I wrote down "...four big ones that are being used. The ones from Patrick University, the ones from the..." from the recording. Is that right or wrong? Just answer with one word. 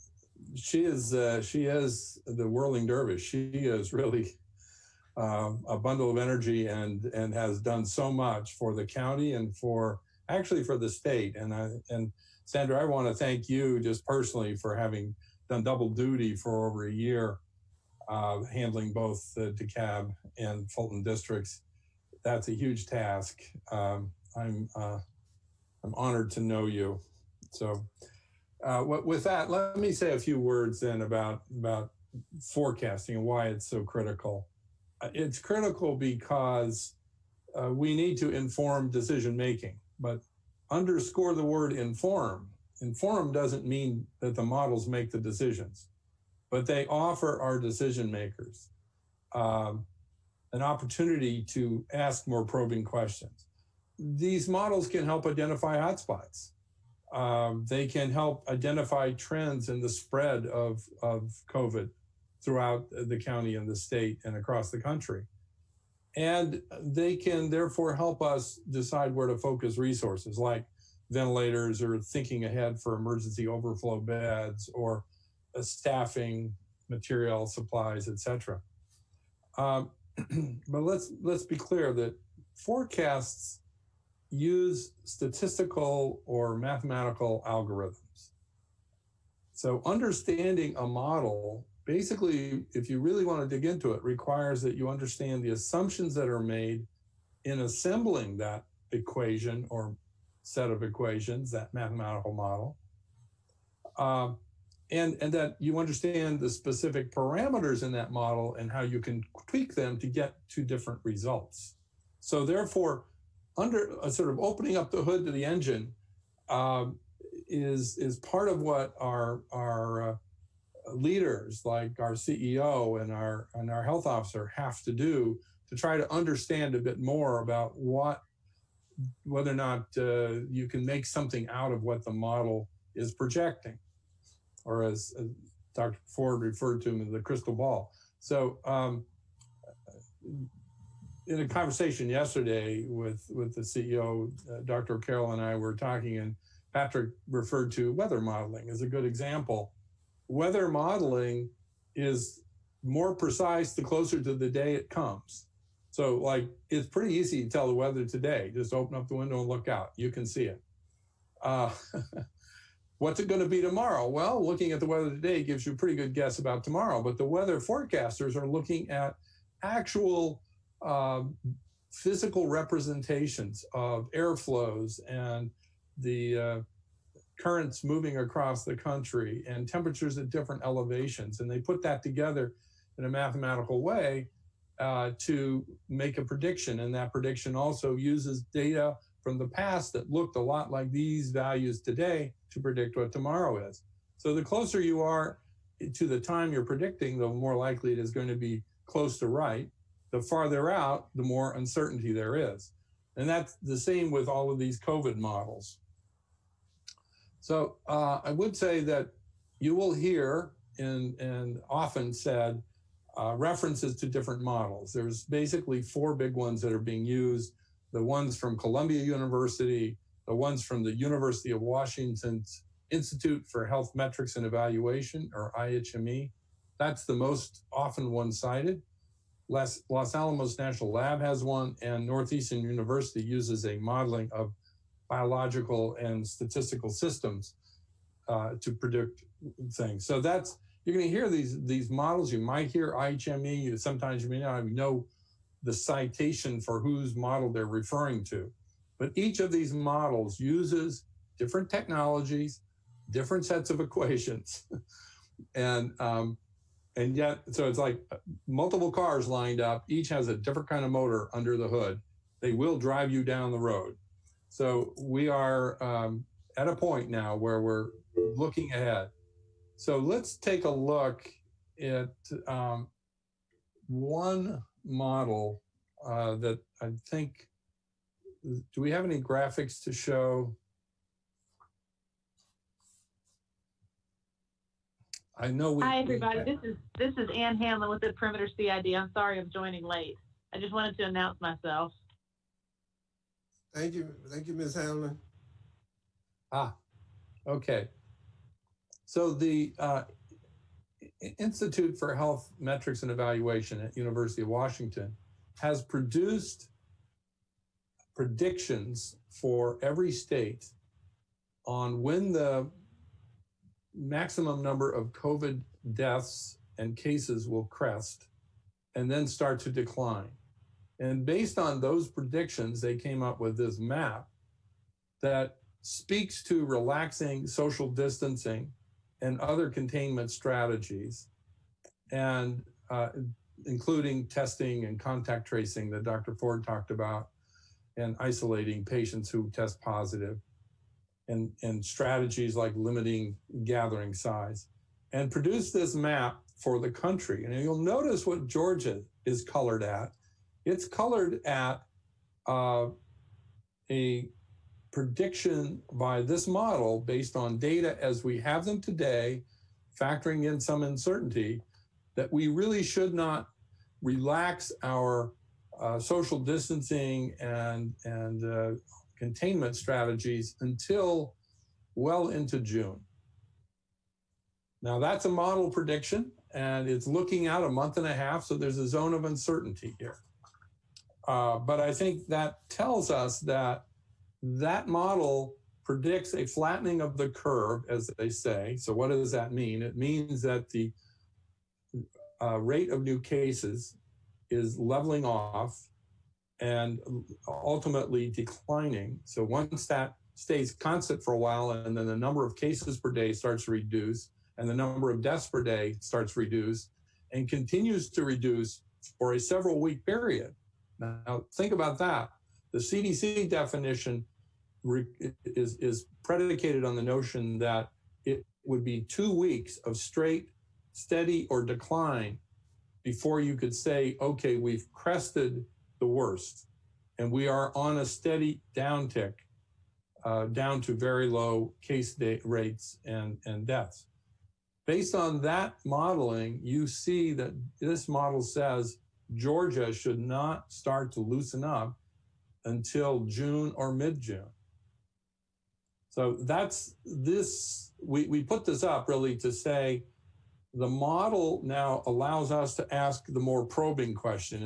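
wrong.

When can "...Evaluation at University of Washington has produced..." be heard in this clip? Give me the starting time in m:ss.
5:03.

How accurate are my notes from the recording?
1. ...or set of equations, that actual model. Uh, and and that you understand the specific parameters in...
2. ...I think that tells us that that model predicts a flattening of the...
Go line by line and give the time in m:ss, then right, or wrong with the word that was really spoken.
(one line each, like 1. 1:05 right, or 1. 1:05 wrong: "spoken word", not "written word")
1. 1:39 wrong: "mathematical", not "actual"
2. 6:21 right.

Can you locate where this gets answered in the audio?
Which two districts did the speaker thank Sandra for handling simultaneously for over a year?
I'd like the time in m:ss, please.
0:19.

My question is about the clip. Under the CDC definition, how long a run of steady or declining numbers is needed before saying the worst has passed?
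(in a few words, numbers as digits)
2 weeks.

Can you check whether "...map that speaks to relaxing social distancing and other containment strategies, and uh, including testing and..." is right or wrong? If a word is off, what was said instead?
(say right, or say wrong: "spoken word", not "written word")
right.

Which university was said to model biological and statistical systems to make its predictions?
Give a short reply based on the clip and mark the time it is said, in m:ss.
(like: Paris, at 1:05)
Northeastern University, at 3:52.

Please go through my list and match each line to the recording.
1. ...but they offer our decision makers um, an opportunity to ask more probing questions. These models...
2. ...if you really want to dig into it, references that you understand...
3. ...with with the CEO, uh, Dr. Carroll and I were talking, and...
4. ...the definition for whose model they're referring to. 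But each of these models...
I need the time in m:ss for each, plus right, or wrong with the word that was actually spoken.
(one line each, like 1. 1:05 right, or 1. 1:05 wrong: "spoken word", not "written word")
1. 0:46 right
2. 1:32 wrong: "requires", not "references"
3. 2:22 right
4. 4:05 wrong: "citation", not "definition".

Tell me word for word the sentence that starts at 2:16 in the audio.
Ford referred to him the crystal ball.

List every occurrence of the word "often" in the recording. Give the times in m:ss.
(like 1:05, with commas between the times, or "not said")
3:31, 3:47.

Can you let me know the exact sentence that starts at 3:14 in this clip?
So the closer you are to the time you're predicting, the more likely it is going to be close to right.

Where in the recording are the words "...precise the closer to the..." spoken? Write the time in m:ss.
2:33.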